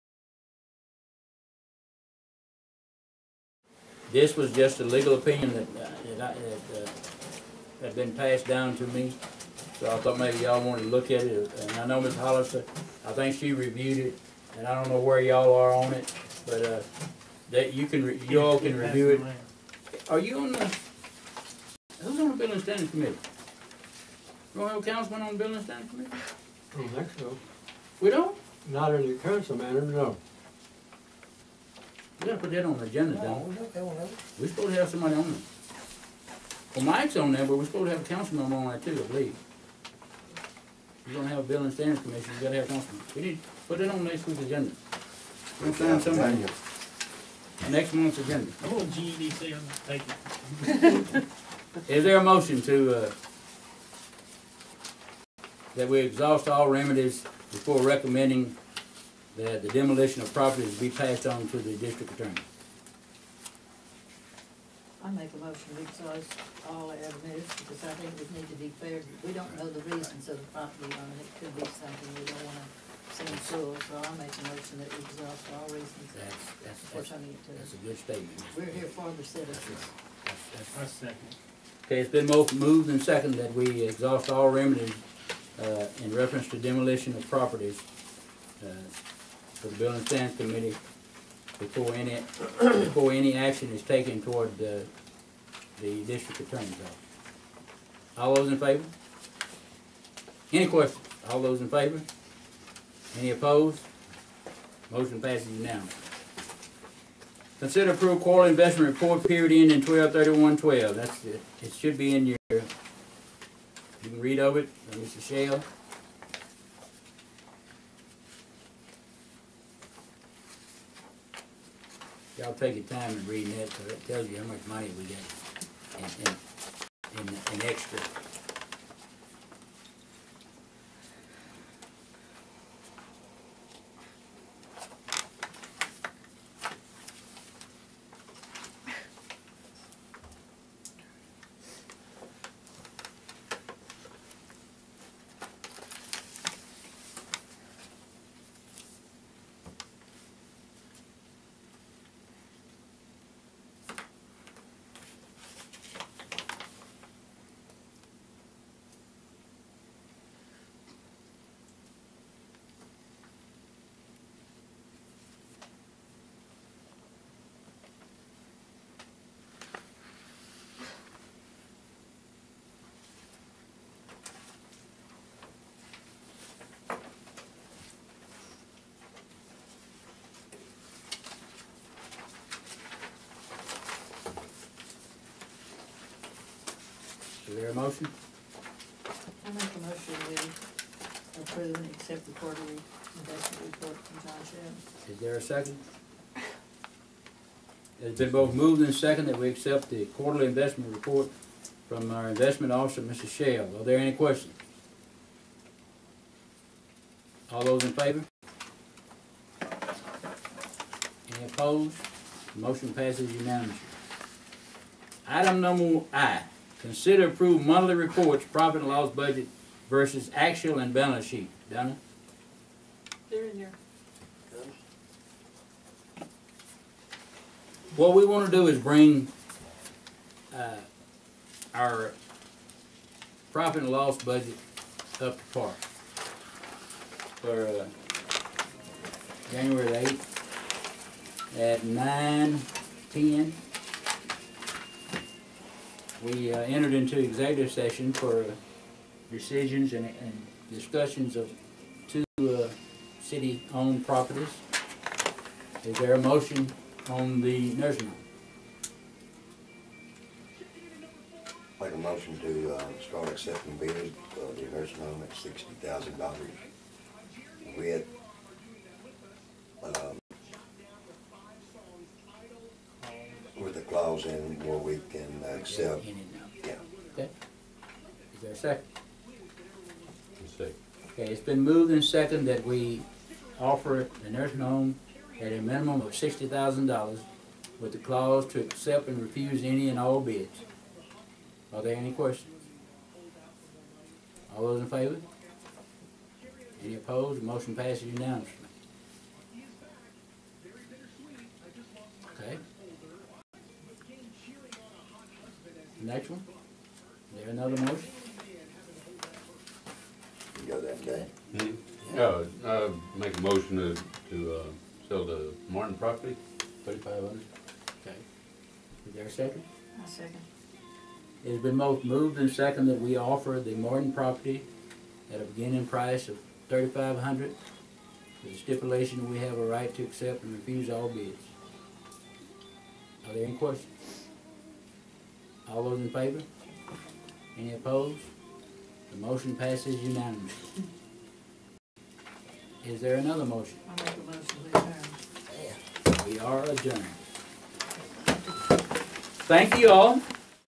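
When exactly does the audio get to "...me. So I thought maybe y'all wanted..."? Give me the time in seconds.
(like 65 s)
8 s.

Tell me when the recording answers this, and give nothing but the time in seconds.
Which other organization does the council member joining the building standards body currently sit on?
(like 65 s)
48 s.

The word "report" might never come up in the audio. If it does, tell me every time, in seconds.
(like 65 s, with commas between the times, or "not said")
108 s, 193 s, 200 s, 217 s.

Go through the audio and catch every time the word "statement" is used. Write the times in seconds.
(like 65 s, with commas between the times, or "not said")
77 s.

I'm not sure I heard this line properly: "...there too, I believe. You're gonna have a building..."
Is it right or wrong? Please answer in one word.
right.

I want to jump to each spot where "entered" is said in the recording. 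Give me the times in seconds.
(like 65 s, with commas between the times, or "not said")
246 s.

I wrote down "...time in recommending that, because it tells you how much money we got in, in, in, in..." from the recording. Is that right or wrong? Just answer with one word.
wrong.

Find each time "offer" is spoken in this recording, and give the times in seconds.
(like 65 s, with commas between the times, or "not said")
283 s, 323 s.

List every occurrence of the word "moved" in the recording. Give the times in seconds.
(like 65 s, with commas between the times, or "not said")
82 s, 198 s, 281 s, 322 s.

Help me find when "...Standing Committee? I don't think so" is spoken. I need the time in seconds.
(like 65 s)
25 s.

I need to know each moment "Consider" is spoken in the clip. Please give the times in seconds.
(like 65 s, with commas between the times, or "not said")
107 s, 216 s.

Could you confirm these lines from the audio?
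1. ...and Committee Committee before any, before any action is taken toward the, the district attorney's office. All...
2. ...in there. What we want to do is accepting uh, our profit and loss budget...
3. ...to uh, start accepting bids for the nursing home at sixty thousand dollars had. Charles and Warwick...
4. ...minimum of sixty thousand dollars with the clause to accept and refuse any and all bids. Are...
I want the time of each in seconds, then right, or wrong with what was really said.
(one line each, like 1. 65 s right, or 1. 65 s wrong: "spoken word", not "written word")
1. 89 s wrong: "Standards", not "Committee"
2. 223 s wrong: "bring", not "accepting"
3. 262 s right
4. 285 s right.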